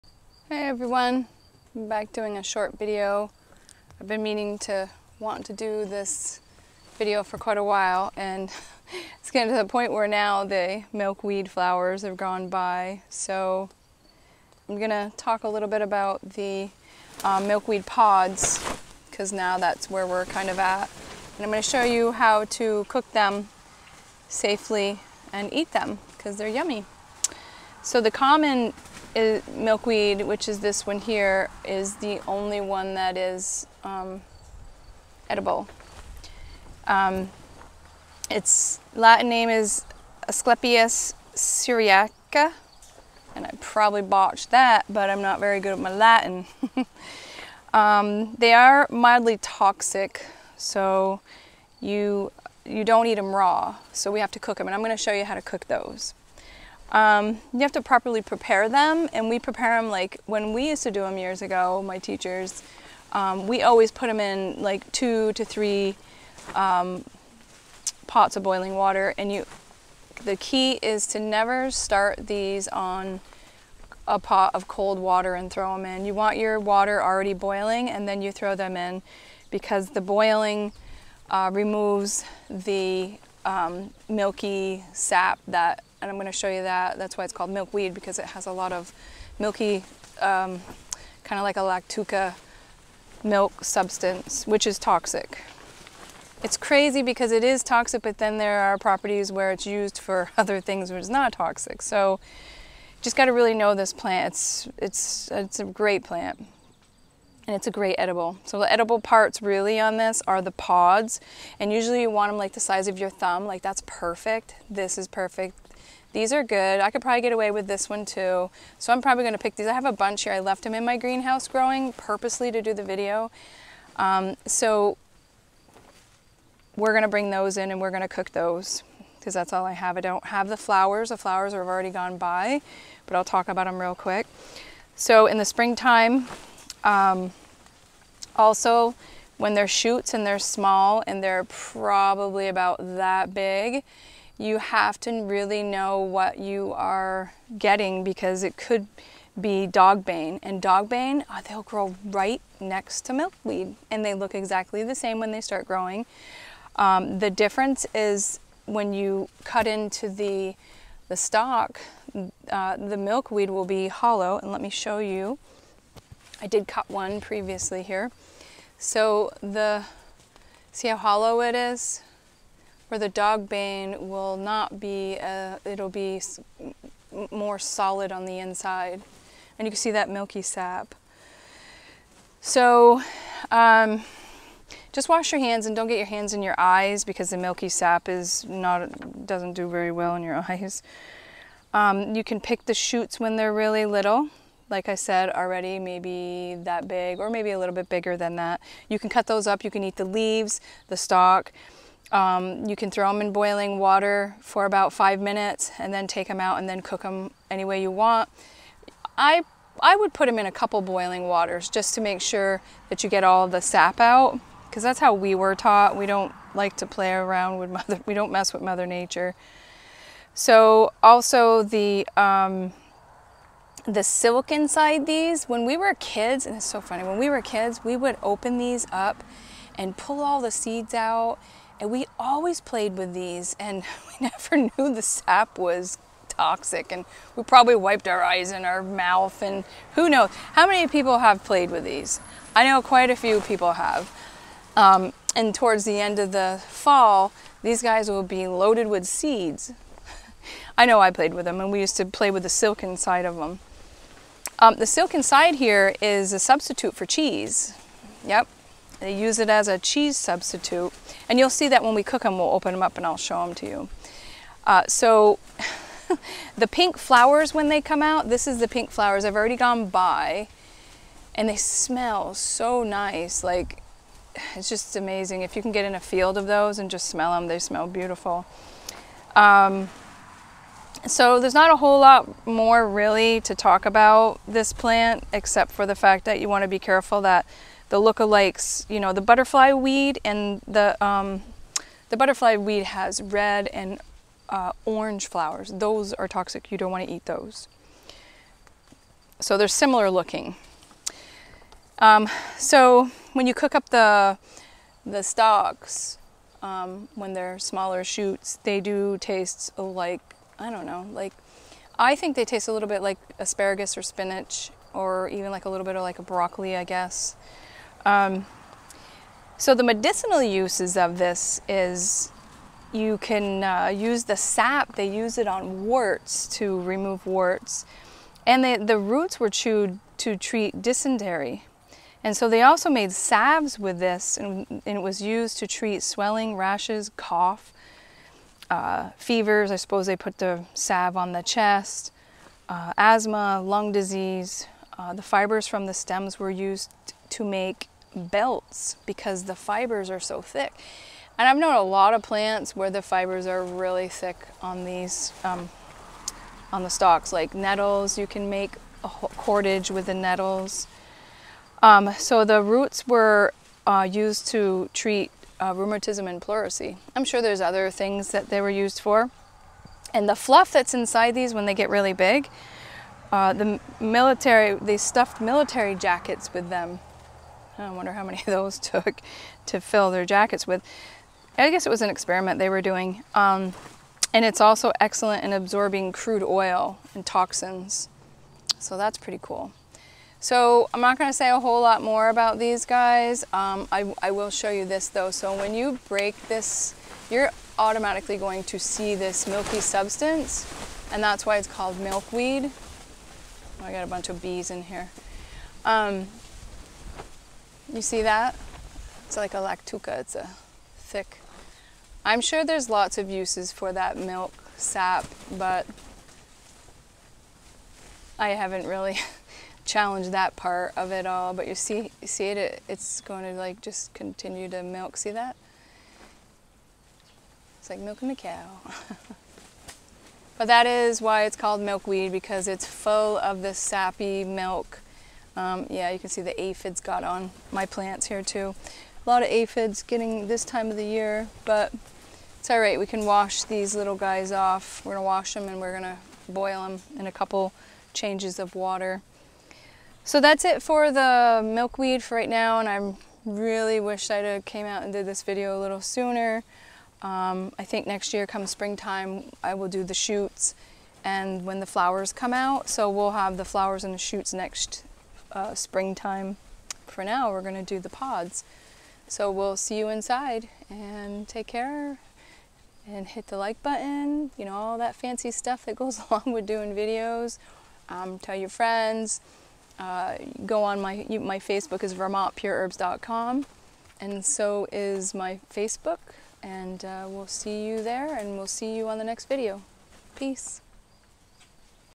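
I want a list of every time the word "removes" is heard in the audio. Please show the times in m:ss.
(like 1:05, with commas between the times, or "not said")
1:21, 5:26.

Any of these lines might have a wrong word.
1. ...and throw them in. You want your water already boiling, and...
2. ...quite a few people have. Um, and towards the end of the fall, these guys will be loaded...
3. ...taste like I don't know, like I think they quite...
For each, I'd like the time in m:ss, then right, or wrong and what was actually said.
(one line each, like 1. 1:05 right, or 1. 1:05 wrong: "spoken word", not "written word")
1. 1:15 right
2. 4:02 right
3. 5:09 wrong: "taste", not "quite".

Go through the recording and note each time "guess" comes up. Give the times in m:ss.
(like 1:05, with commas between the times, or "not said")
5:16, 6:21.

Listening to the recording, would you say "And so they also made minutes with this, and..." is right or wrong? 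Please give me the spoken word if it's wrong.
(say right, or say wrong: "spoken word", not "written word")
wrong: "salves", not "minutes".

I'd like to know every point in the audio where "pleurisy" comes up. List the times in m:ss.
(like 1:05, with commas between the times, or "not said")
6:06.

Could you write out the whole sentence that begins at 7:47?
For now, we're going to do the pods.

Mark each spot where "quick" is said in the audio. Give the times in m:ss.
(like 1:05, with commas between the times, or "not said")
2:13.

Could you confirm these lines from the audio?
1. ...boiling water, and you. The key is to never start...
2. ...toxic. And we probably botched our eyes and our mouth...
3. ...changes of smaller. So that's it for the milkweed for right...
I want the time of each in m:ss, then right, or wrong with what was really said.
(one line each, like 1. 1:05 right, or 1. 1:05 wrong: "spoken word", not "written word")
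1. 1:08 right
2. 3:56 wrong: "wiped", not "botched"
3. 7:28 wrong: "water", not "smaller".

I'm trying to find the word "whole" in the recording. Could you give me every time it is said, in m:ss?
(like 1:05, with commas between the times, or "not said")
4:41, 6:31.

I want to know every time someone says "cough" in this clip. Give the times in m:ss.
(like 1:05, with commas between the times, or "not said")
5:37.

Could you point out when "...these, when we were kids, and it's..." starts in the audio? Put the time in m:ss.
3:45.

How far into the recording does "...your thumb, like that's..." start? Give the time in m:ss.
1:52.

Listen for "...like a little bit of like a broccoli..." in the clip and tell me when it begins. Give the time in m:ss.
5:15.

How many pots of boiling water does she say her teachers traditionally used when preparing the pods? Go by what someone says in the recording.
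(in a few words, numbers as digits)
2 to 3.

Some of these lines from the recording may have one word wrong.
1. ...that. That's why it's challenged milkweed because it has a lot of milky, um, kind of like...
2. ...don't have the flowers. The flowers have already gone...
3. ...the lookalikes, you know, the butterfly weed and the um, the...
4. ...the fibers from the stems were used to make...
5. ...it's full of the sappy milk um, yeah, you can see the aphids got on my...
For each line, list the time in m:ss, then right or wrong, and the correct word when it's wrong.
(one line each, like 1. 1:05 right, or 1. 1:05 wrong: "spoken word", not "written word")
1. 1:26 wrong: "called", not "challenged"
2. 2:10 right
3. 4:47 right
4. 5:45 right
5. 7:12 right.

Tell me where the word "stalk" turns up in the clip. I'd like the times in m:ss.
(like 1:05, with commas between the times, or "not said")
2:41, 3:20, 5:05, 5:56.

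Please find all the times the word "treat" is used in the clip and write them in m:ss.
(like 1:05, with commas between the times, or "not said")
5:30, 5:35, 6:04.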